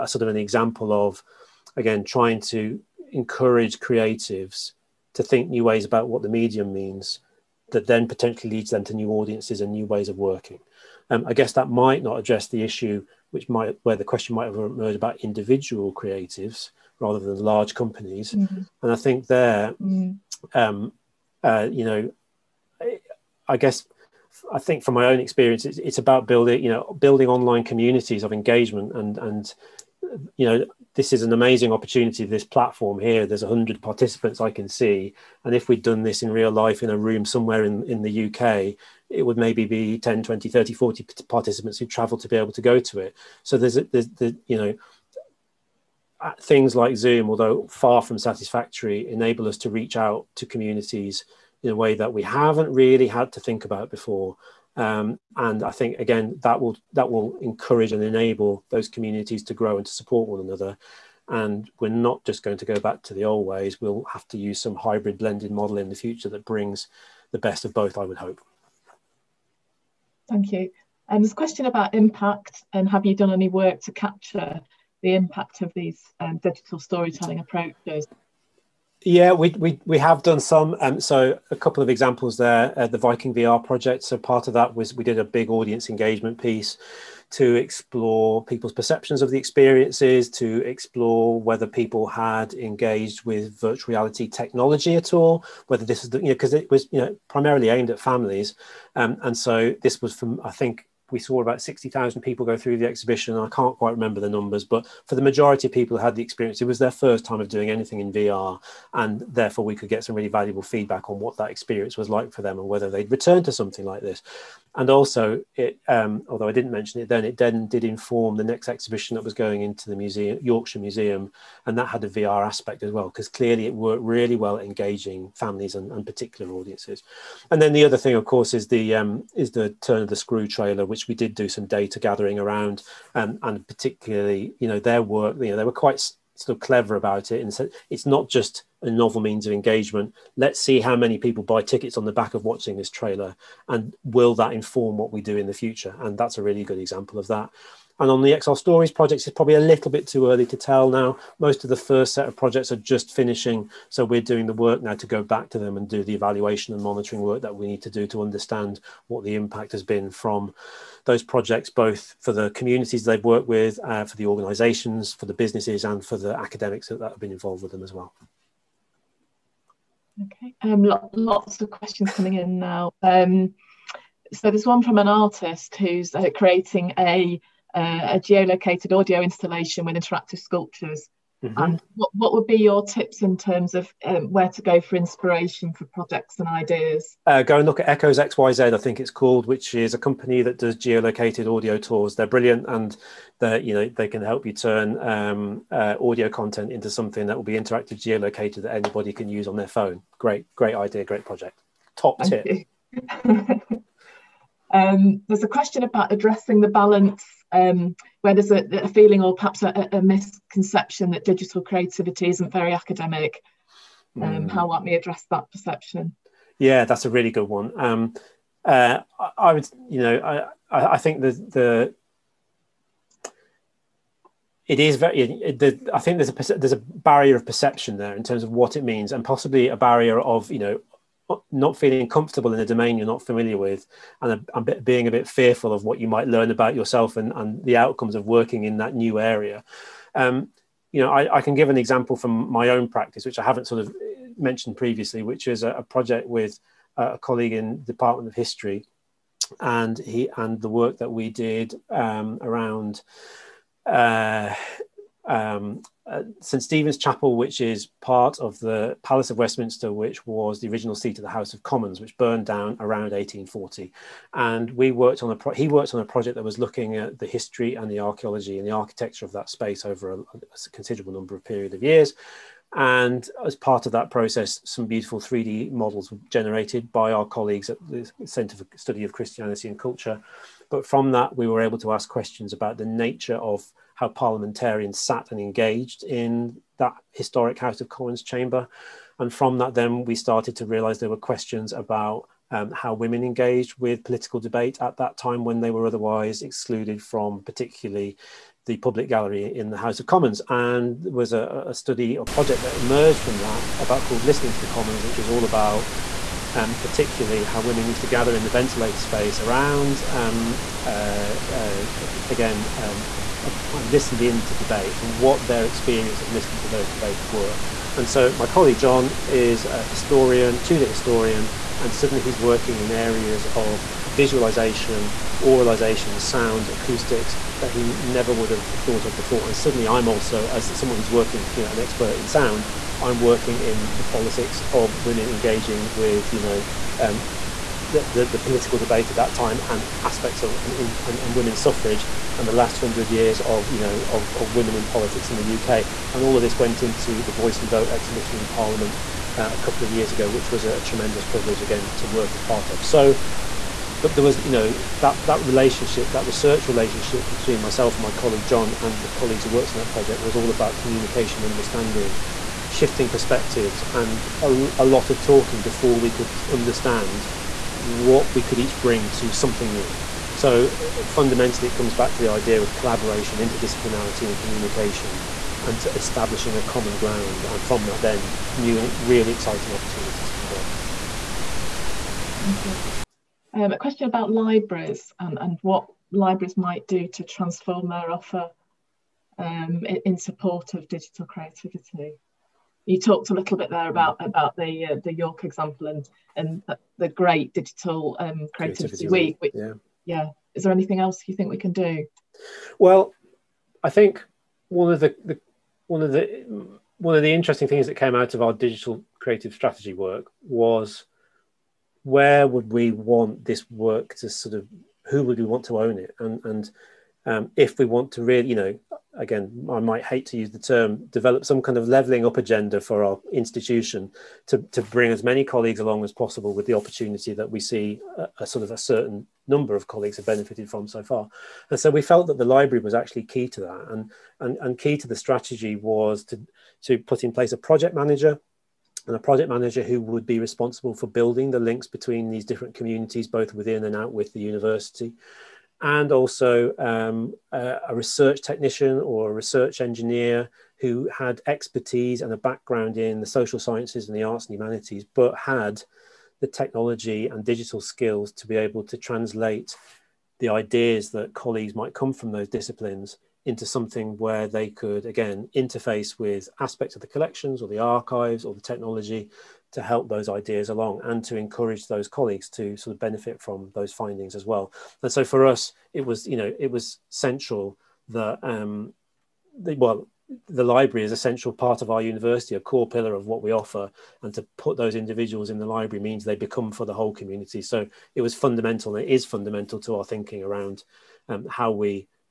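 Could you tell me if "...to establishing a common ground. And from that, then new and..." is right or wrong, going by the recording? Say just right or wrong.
right.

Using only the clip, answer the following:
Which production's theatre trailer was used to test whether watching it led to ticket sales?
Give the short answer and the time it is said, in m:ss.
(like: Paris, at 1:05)
The Turn of the Screw, at 2:09.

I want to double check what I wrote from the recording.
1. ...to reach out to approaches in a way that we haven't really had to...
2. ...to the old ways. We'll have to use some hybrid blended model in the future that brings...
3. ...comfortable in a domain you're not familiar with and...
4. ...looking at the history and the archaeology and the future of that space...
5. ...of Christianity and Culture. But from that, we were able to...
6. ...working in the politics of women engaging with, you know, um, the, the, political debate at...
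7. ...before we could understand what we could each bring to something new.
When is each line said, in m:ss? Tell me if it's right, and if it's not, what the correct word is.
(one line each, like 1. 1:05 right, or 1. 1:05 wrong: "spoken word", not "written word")
1. 0:49 wrong: "communities", not "approaches"
2. 1:03 right
3. 3:52 right
4. 4:26 wrong: "architecture", not "future"
5. 4:39 right
6. 5:33 right
7. 6:05 right.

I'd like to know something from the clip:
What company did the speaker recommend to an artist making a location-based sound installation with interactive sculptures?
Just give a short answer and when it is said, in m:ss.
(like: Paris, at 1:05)
Echoes XYZ, at 3:07.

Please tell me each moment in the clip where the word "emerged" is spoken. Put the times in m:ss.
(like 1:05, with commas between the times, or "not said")
0:14, 5:02.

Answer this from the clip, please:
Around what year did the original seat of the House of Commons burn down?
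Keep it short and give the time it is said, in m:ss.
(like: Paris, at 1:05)
1840, at 4:23.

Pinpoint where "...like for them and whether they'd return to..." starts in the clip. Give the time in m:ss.
1:52.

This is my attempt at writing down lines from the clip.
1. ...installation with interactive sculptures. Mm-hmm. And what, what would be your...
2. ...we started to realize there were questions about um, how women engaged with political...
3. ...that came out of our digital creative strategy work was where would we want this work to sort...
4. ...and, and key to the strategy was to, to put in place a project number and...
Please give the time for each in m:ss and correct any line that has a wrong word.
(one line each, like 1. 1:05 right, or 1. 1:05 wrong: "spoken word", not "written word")
1. 2:59 right
2. 4:50 right
3. 6:47 right
4. 7:14 wrong: "manager", not "number".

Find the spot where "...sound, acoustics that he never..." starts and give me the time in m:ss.
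5:26.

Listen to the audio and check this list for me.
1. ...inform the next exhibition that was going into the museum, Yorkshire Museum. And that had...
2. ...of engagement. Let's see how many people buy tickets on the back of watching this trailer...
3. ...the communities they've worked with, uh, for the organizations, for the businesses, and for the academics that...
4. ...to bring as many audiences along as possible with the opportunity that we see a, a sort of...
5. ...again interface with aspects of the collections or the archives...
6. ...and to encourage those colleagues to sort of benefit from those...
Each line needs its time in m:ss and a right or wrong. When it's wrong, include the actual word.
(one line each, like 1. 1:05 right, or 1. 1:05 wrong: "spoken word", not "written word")
1. 1:57 right
2. 2:19 right
3. 2:42 right
4. 7:04 wrong: "colleagues", not "audiences"
5. 7:45 right
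6. 7:51 right.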